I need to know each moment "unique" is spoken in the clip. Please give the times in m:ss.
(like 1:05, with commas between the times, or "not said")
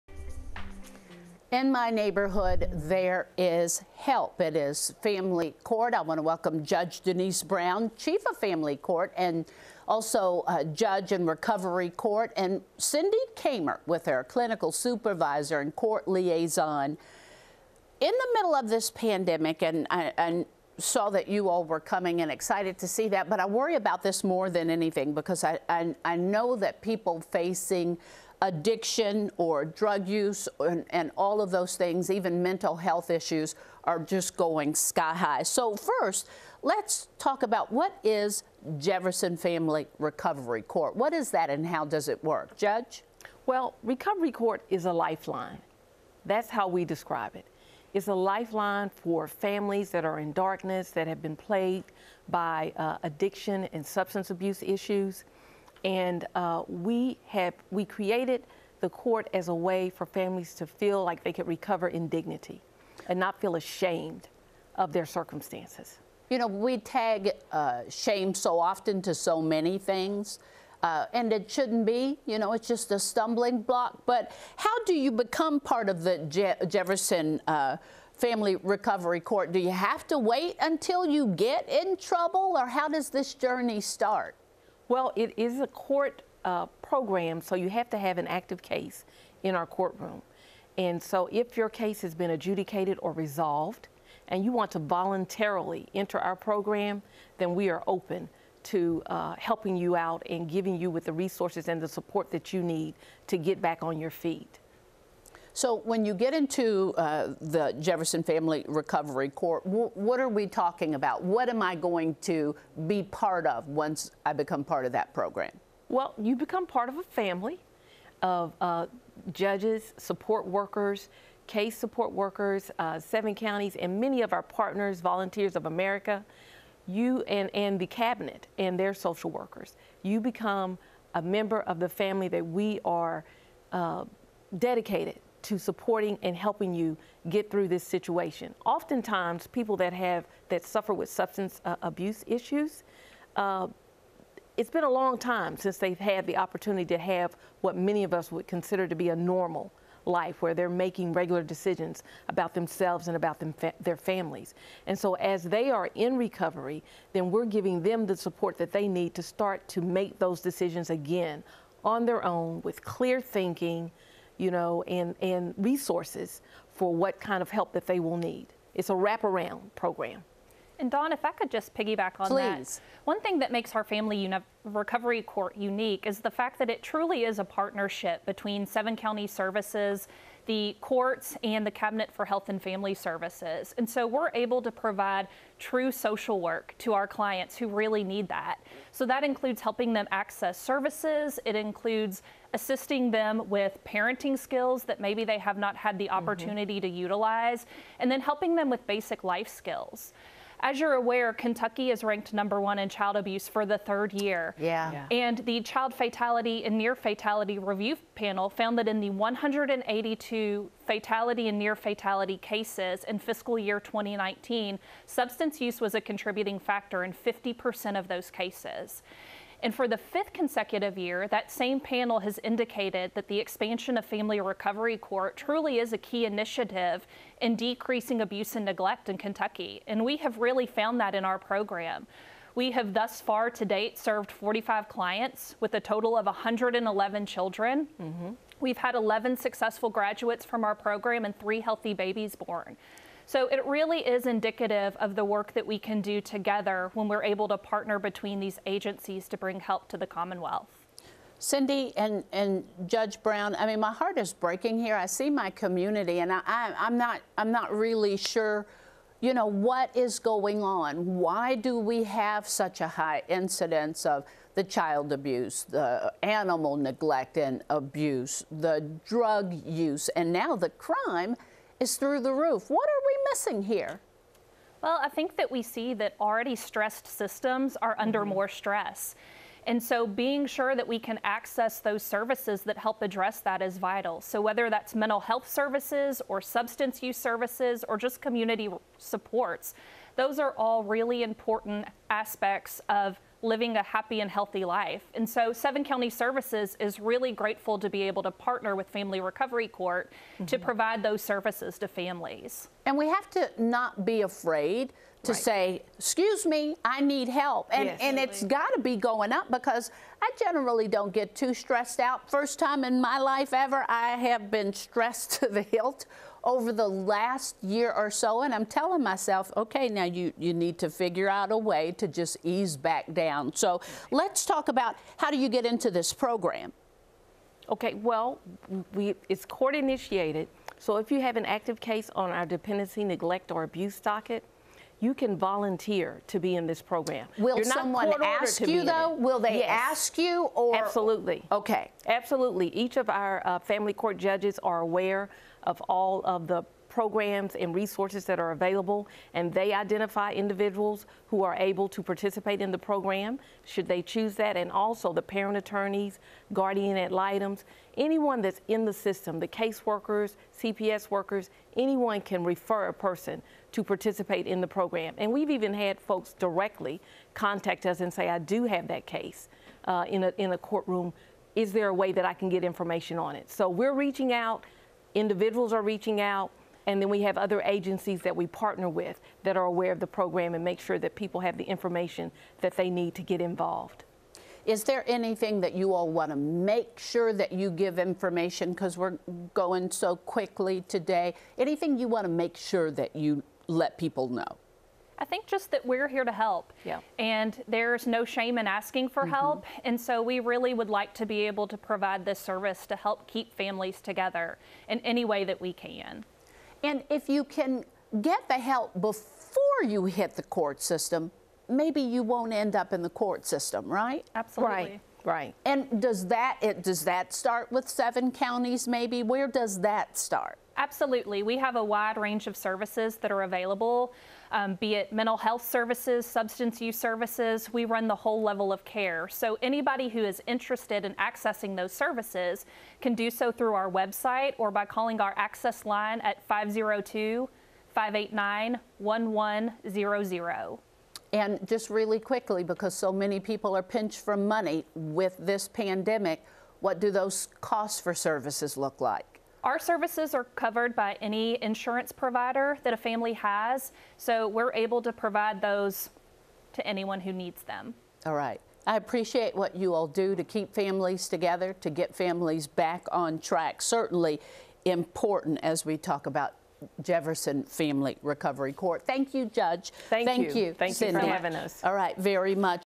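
2:55.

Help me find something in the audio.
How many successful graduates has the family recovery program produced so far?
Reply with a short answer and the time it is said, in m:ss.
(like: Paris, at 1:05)
11, at 3:58.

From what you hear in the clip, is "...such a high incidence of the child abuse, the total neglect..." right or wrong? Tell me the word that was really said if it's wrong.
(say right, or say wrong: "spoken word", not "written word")
wrong: "animal", not "total".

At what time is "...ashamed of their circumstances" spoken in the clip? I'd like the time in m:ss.
1:03.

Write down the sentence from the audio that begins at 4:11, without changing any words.
Cindy and, and Judge Brown, I mean, my heart is breaking here.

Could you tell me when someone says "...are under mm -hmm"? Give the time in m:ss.
4:37.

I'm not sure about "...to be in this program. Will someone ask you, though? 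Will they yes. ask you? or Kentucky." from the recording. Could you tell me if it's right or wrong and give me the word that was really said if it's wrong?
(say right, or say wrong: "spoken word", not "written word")
wrong: "Absolutely", not "Kentucky".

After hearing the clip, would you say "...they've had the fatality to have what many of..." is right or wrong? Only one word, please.
wrong.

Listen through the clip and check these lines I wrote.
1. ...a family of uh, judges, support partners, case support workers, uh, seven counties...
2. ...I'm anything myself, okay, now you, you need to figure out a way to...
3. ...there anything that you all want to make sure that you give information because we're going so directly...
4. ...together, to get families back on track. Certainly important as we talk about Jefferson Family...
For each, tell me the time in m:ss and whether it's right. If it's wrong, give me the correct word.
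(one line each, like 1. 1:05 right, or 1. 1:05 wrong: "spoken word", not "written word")
1. 1:56 wrong: "workers", not "partners"
2. 5:18 wrong: "telling", not "anything"
3. 6:24 wrong: "quickly", not "directly"
4. 7:41 right.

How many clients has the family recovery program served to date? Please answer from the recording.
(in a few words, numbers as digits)
45.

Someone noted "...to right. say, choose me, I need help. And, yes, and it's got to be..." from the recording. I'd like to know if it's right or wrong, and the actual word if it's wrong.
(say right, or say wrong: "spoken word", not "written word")
wrong: "excuse", not "choose".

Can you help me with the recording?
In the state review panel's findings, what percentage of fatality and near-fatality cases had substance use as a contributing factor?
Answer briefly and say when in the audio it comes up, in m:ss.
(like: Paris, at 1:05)
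50%, at 3:37.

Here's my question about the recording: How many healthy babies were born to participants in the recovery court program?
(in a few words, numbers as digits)
3.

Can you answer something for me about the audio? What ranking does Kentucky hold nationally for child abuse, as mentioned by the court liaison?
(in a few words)
Number one.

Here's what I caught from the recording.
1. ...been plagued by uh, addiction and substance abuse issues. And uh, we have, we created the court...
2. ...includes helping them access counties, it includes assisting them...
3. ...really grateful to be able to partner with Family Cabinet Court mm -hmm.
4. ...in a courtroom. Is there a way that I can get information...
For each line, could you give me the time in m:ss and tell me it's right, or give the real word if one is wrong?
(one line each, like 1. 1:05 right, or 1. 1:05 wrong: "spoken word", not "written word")
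1. 0:51 right
2. 3:09 wrong: "services", not "counties"
3. 4:56 wrong: "Recovery", not "Cabinet"
4. 6:10 right.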